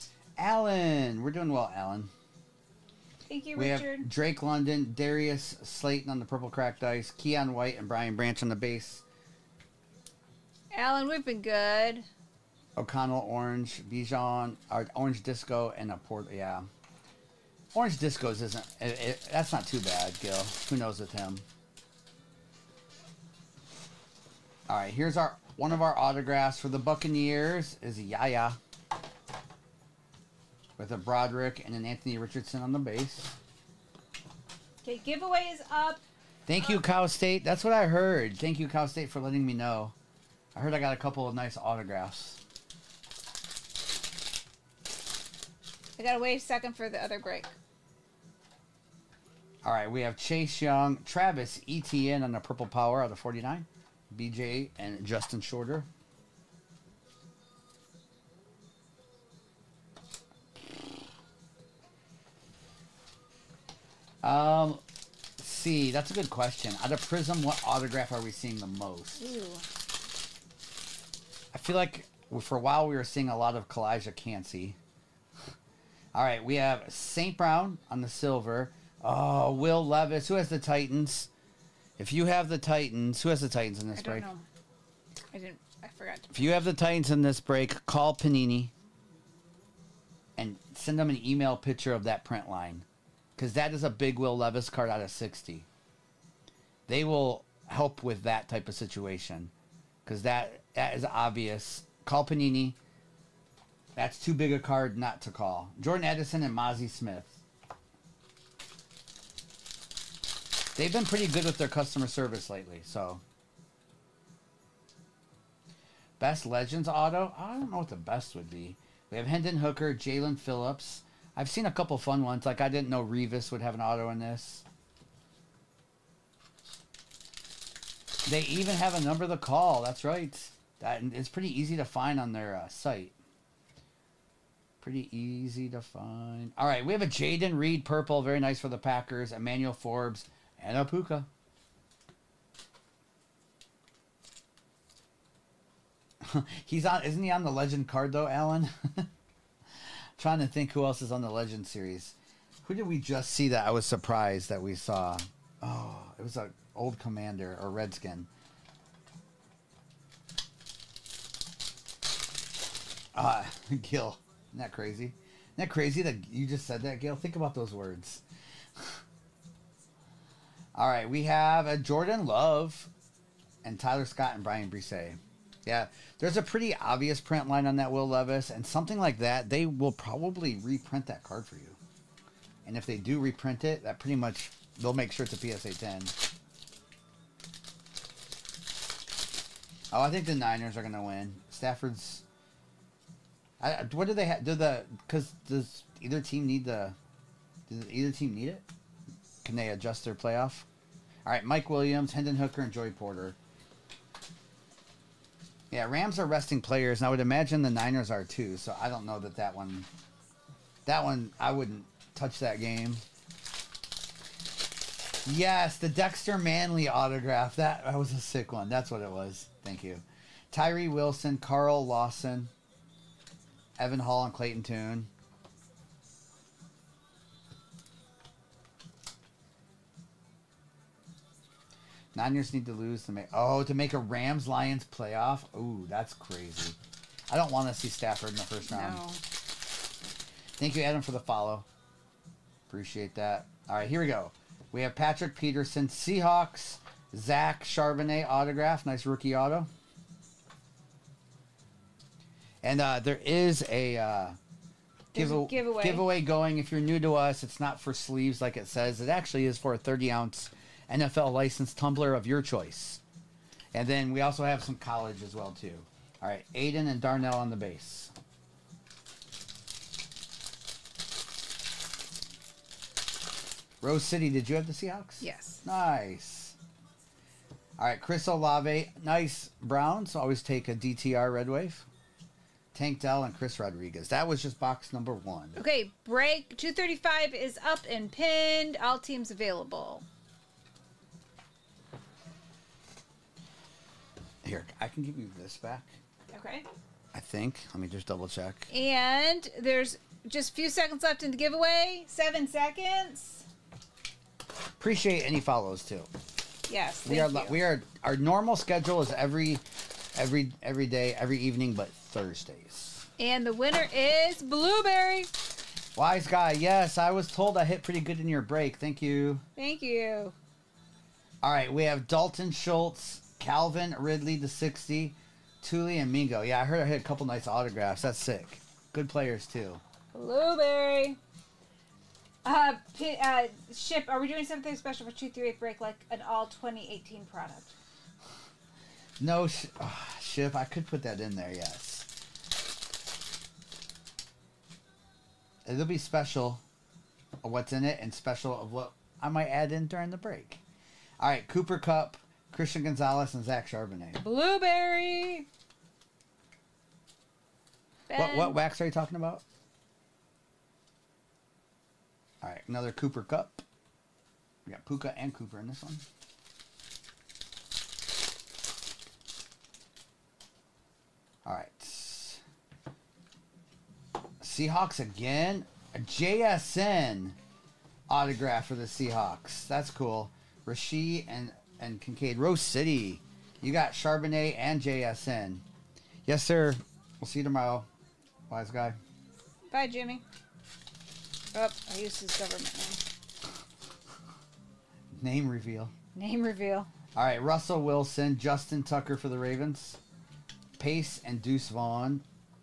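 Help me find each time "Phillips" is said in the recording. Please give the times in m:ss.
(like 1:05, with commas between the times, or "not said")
2:00.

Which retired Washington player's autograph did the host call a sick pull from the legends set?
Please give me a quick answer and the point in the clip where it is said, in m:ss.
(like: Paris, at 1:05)
Dexter Manley, at 3:35.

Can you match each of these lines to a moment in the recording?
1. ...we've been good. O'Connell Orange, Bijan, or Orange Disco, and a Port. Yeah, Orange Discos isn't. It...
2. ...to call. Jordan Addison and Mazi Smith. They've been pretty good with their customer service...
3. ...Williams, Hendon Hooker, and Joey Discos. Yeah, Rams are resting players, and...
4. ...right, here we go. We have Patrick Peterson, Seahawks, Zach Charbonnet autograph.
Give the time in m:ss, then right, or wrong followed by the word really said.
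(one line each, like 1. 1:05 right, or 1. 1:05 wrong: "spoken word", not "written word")
1. 0:11 right
2. 1:45 right
3. 3:21 wrong: "Porter", not "Discos"
4. 4:03 right.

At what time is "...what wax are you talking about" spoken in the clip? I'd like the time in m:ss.
5:58.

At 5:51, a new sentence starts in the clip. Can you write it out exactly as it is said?
All right, Cooper Kupp, Christian Gonzalez, and Zach Charbonnet.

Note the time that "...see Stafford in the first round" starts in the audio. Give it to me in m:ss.
3:57.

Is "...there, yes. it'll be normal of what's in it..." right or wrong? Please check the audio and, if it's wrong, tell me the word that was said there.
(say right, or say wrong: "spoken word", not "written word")
wrong: "special", not "normal".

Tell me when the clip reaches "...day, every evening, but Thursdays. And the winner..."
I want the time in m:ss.
5:10.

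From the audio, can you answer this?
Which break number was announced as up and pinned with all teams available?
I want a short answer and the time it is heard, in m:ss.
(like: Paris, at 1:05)
235, at 4:46.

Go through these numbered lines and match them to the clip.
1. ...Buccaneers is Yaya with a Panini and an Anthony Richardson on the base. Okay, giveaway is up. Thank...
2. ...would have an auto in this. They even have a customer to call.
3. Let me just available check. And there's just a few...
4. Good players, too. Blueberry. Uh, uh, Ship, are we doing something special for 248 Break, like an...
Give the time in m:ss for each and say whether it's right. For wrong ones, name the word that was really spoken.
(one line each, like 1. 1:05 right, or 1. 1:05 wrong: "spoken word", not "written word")
1. 0:26 wrong: "Broderick", not "Panini"
2. 2:03 wrong: "number", not "customer"
3. 4:57 wrong: "double", not "available"
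4. 5:28 wrong: "238", not "248".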